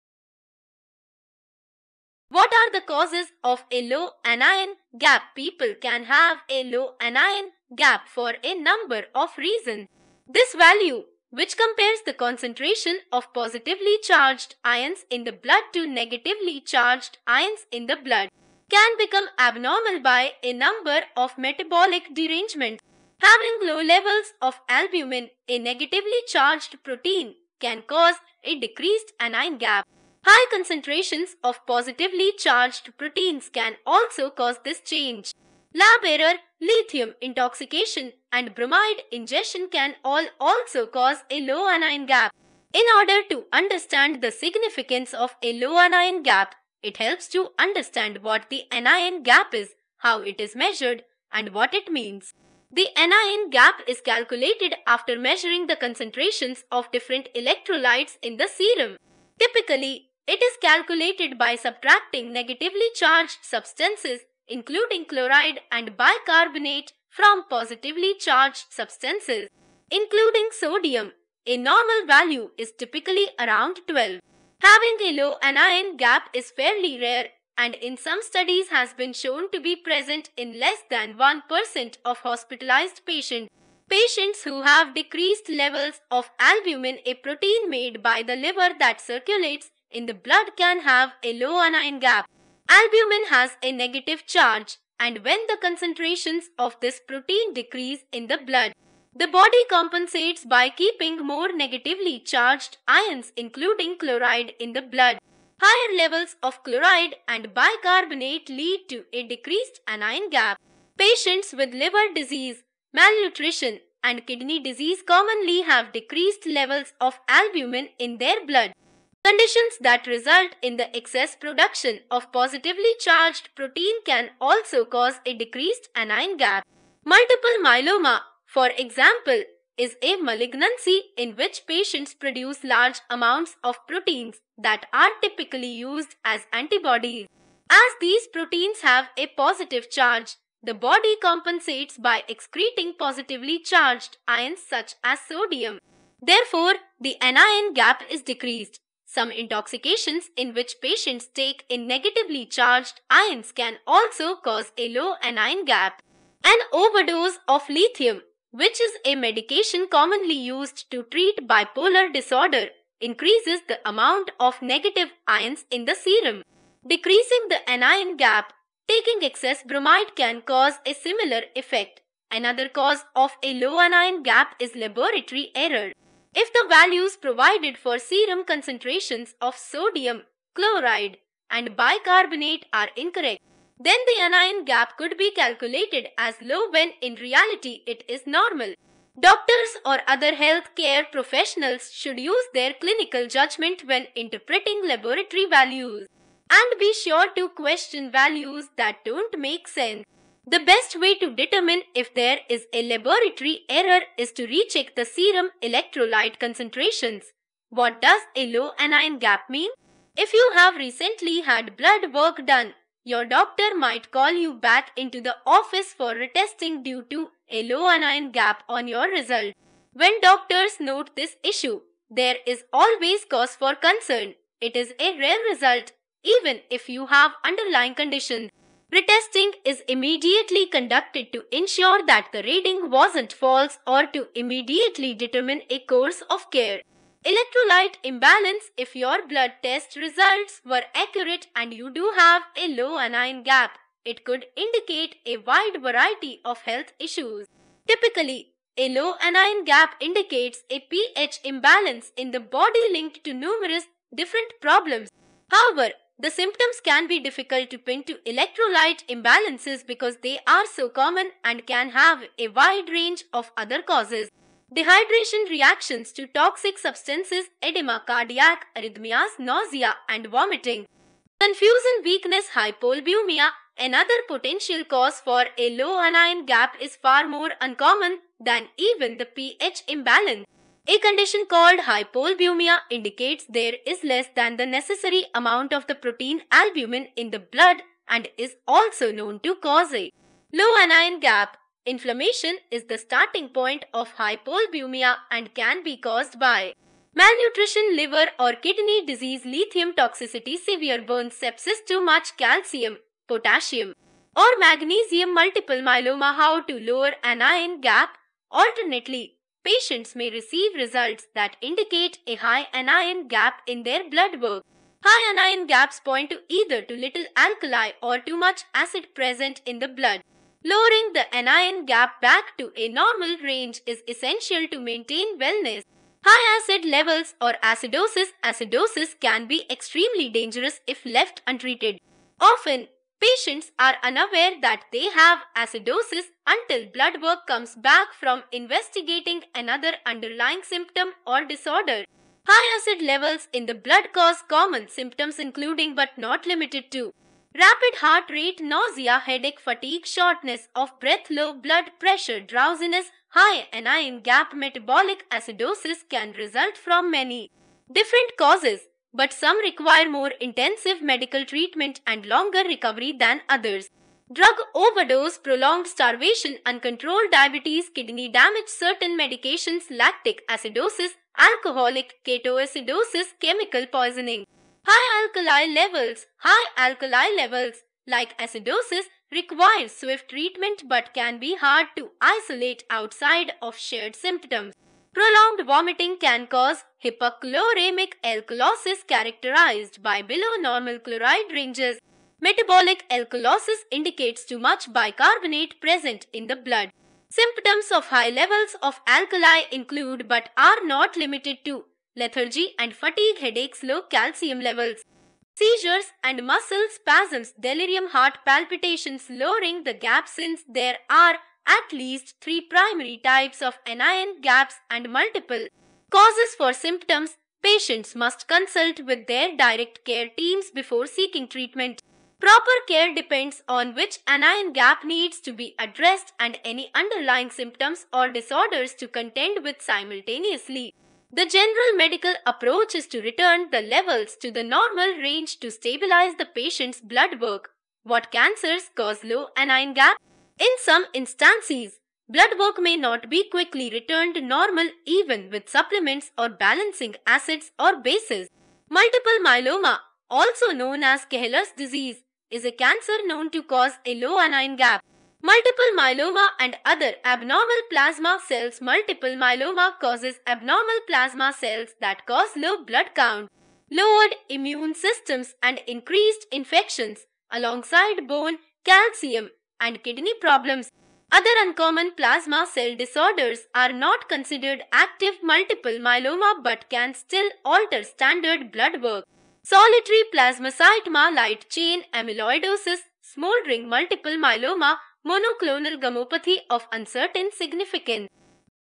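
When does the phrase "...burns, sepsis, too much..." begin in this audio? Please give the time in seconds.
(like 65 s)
301 s.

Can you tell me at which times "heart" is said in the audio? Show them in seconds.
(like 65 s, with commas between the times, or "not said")
347 s, 408 s.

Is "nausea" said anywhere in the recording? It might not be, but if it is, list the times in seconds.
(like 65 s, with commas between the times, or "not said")
269 s, 348 s.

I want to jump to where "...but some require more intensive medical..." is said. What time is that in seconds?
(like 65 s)
359 s.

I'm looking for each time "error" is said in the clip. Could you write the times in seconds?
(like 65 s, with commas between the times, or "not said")
36 s, 175 s, 203 s.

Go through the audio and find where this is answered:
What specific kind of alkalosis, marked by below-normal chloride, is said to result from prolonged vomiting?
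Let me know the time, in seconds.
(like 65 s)
387 s.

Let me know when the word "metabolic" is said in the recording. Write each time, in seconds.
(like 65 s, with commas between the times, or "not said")
21 s, 354 s, 392 s.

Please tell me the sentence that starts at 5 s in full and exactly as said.
People can have a low anion gap for a number of reasons.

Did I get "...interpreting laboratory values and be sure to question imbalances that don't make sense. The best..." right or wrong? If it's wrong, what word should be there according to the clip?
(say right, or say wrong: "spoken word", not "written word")
wrong: "values", not "imbalances".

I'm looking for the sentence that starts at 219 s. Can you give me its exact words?
When doctors note this issue, there is always cause for concern.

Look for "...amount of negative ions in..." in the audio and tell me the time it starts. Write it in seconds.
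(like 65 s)
163 s.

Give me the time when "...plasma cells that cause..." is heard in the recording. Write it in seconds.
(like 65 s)
461 s.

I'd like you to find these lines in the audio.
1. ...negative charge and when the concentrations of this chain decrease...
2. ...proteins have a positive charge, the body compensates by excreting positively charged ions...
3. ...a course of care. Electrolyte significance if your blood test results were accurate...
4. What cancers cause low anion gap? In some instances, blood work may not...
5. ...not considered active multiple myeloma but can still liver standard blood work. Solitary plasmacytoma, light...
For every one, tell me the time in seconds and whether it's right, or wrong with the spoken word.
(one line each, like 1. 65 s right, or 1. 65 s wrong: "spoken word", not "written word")
1. 93 s wrong: "protein", not "chain"
2. 138 s right
3. 235 s wrong: "imbalance", not "significance"
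4. 438 s right
5. 473 s wrong: "alter", not "liver".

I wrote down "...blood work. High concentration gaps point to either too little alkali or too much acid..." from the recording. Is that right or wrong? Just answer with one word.
wrong.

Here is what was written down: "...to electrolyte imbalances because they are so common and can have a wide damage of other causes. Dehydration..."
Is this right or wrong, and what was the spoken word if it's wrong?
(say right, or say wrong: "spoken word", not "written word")
wrong: "range", not "damage".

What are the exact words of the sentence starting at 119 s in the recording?
Conditions that result in the excess production of positively charged protein can also cause a decreased anion gap.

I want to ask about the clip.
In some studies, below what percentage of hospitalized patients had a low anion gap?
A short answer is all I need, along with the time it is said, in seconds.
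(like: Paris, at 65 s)
less than 1%, at 80 s.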